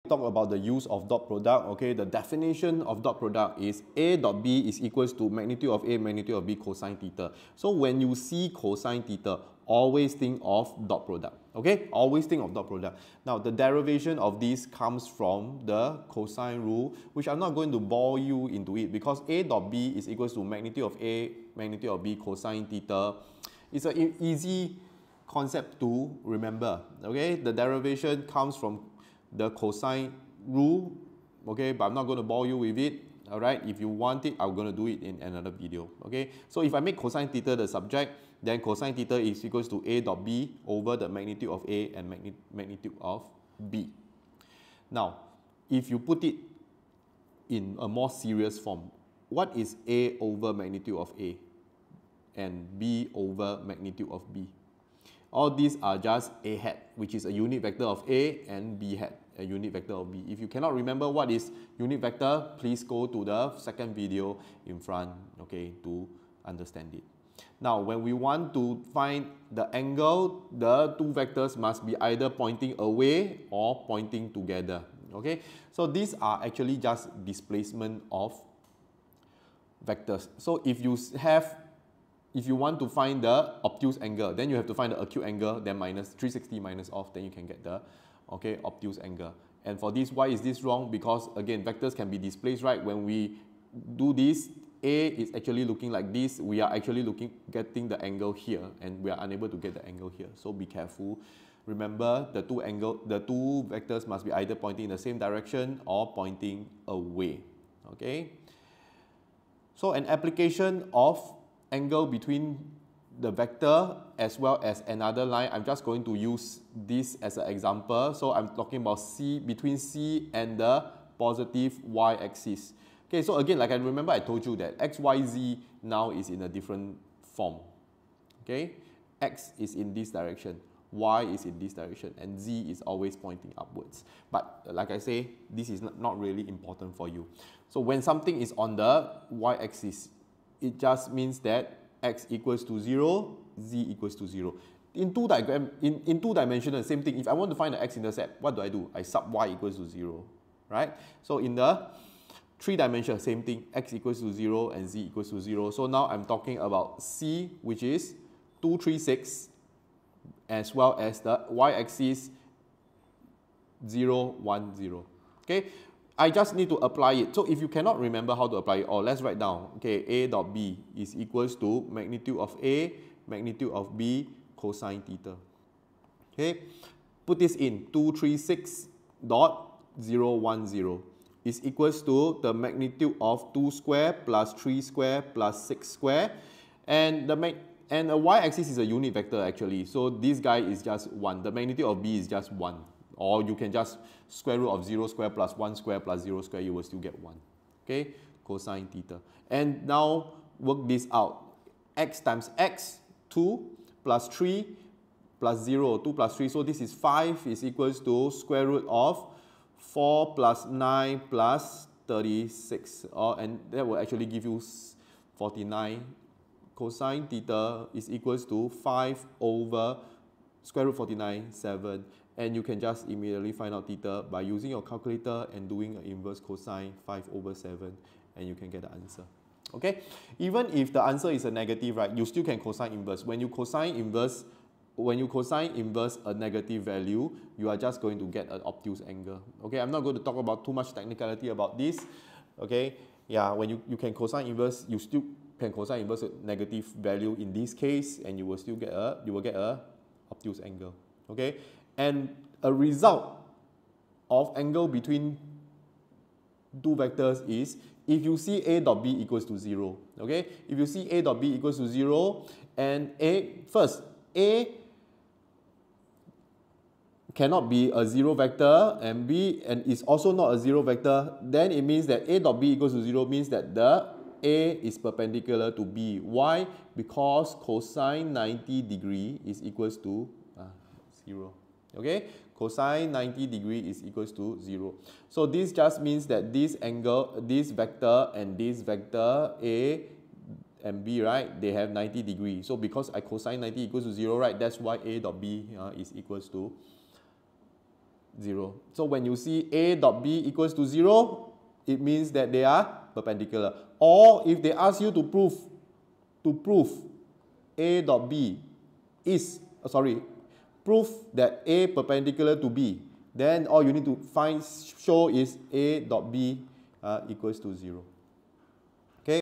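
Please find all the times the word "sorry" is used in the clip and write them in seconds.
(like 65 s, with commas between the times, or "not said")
309 s.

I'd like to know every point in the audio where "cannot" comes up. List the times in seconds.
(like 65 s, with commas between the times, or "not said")
60 s, 167 s, 267 s.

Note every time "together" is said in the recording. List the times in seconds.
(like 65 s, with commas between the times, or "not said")
74 s.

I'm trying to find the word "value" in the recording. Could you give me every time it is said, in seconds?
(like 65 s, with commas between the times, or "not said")
236 s, 246 s.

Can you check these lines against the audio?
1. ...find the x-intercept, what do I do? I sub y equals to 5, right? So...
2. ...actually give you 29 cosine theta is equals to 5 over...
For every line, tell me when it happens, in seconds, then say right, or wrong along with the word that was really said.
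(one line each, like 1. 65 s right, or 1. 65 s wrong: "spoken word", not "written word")
1. 147 s wrong: "0", not "5"
2. 213 s wrong: "49", not "29".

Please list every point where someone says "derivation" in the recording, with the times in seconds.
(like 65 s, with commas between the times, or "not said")
13 s, 27 s.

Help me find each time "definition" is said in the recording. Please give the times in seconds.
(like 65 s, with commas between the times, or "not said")
2 s.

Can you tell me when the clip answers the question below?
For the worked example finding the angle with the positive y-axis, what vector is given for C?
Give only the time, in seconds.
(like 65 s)
158 s.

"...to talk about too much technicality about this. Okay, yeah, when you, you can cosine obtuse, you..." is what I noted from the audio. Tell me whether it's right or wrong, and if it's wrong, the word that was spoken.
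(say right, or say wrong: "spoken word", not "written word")
wrong: "inverse", not "obtuse".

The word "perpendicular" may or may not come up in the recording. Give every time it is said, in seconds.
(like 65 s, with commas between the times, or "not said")
274 s, 303 s, 311 s.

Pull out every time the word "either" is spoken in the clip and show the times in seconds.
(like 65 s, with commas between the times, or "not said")
72 s, 104 s.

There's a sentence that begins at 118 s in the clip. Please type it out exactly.
So I'm talking about C between C and the positive y-axis.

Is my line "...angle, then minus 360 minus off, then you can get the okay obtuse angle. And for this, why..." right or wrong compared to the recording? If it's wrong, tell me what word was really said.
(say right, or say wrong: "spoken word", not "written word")
right.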